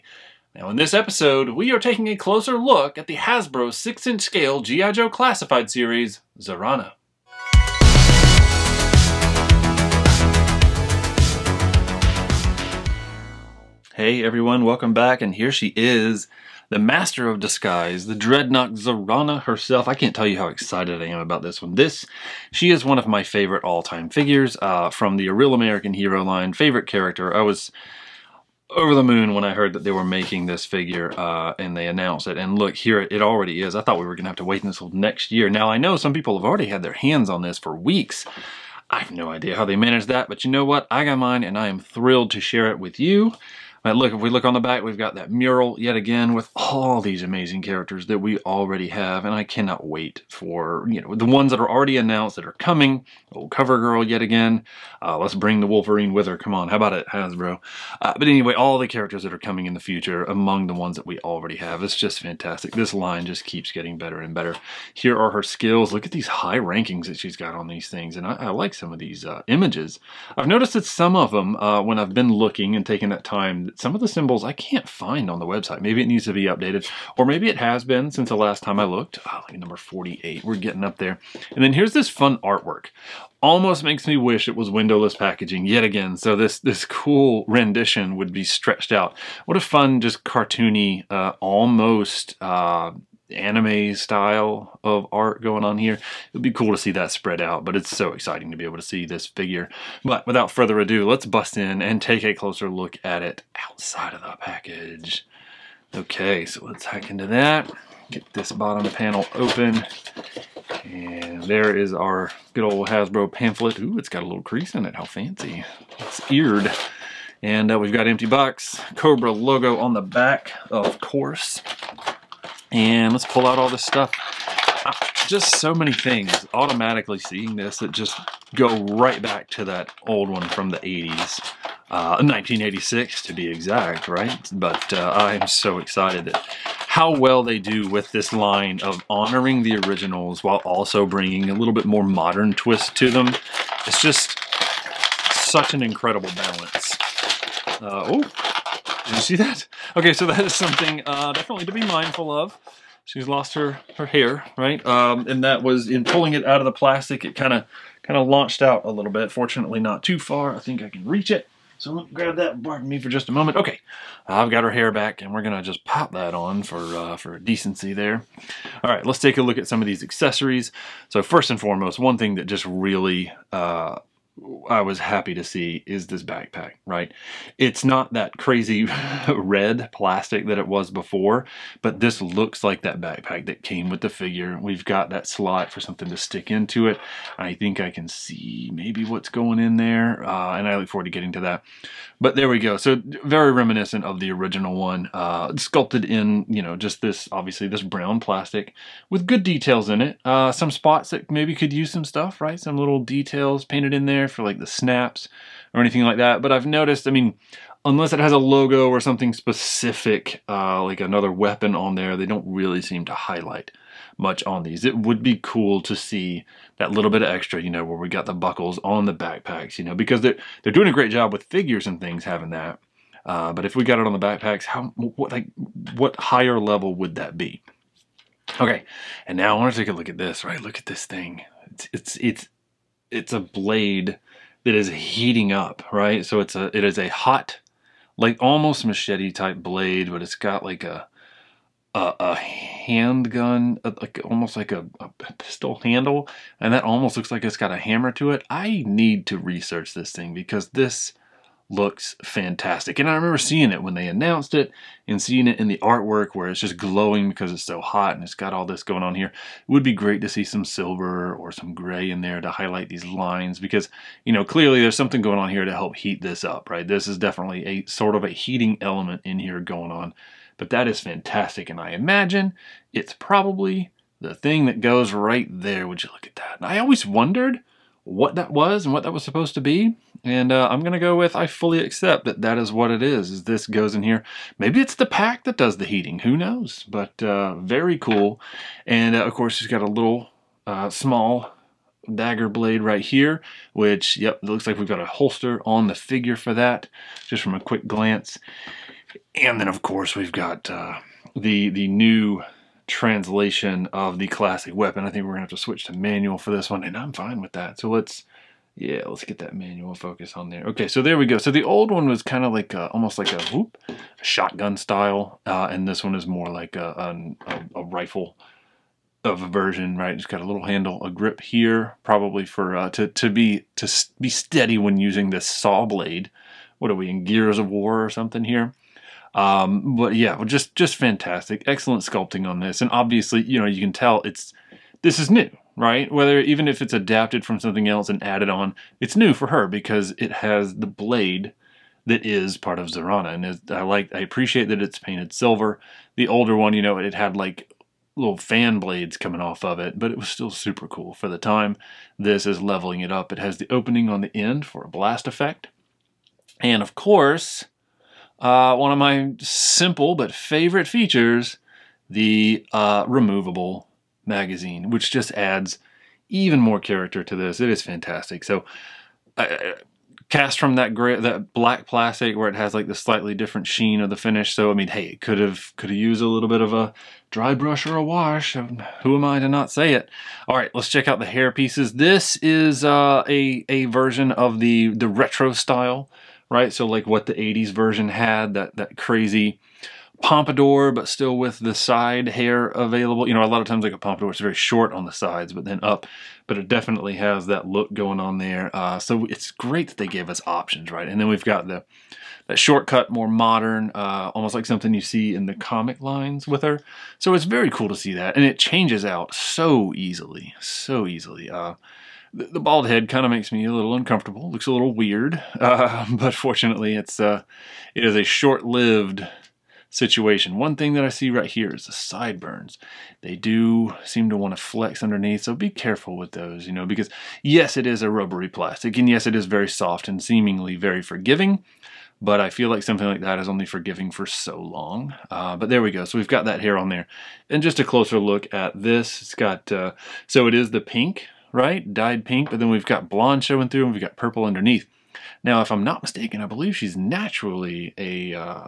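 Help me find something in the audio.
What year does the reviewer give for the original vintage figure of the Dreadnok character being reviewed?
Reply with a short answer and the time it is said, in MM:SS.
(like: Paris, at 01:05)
1986, at 02:12.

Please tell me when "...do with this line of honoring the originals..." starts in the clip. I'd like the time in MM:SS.
02:17.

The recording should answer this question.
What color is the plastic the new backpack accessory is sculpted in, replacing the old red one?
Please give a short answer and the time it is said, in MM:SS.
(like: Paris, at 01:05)
Brown, at 03:17.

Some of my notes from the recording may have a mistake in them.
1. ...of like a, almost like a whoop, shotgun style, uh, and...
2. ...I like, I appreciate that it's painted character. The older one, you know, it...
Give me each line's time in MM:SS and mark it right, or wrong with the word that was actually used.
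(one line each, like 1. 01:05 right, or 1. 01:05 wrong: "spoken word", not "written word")
1. 05:12 right
2. 05:43 wrong: "silver", not "character".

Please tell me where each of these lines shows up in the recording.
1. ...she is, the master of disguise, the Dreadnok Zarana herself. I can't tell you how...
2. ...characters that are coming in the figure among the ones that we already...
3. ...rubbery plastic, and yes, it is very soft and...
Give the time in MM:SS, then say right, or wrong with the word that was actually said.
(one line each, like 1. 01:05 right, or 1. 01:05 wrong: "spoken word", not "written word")
1. 00:15 right
2. 00:58 wrong: "future", not "figure"
3. 07:08 right.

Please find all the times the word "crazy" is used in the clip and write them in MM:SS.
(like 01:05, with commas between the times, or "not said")
02:58, 06:28.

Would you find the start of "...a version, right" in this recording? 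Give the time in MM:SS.
05:19.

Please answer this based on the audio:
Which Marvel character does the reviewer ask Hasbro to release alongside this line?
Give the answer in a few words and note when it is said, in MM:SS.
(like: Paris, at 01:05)
Wolverine, at 00:55.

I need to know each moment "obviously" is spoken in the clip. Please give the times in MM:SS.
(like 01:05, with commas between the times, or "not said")
03:17, 05:32.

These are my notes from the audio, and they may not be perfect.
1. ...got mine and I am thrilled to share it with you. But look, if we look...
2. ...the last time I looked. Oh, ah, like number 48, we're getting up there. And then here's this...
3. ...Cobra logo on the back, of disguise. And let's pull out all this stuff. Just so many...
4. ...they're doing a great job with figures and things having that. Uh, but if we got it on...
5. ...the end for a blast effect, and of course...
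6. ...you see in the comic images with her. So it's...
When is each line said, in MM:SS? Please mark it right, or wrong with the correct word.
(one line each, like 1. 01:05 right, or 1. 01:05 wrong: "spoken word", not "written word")
1. 00:41 right
2. 01:18 right
3. 01:58 wrong: "course", not "disguise"
4. 03:40 right
5. 05:54 right
6. 06:44 wrong: "lines", not "images".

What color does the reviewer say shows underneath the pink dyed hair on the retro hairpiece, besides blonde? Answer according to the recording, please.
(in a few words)
Purple.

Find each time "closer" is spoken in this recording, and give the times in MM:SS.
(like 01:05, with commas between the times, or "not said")
00:02, 01:42, 07:17.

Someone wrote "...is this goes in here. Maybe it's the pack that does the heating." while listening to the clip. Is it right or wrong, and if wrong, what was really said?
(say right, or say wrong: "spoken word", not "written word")
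right.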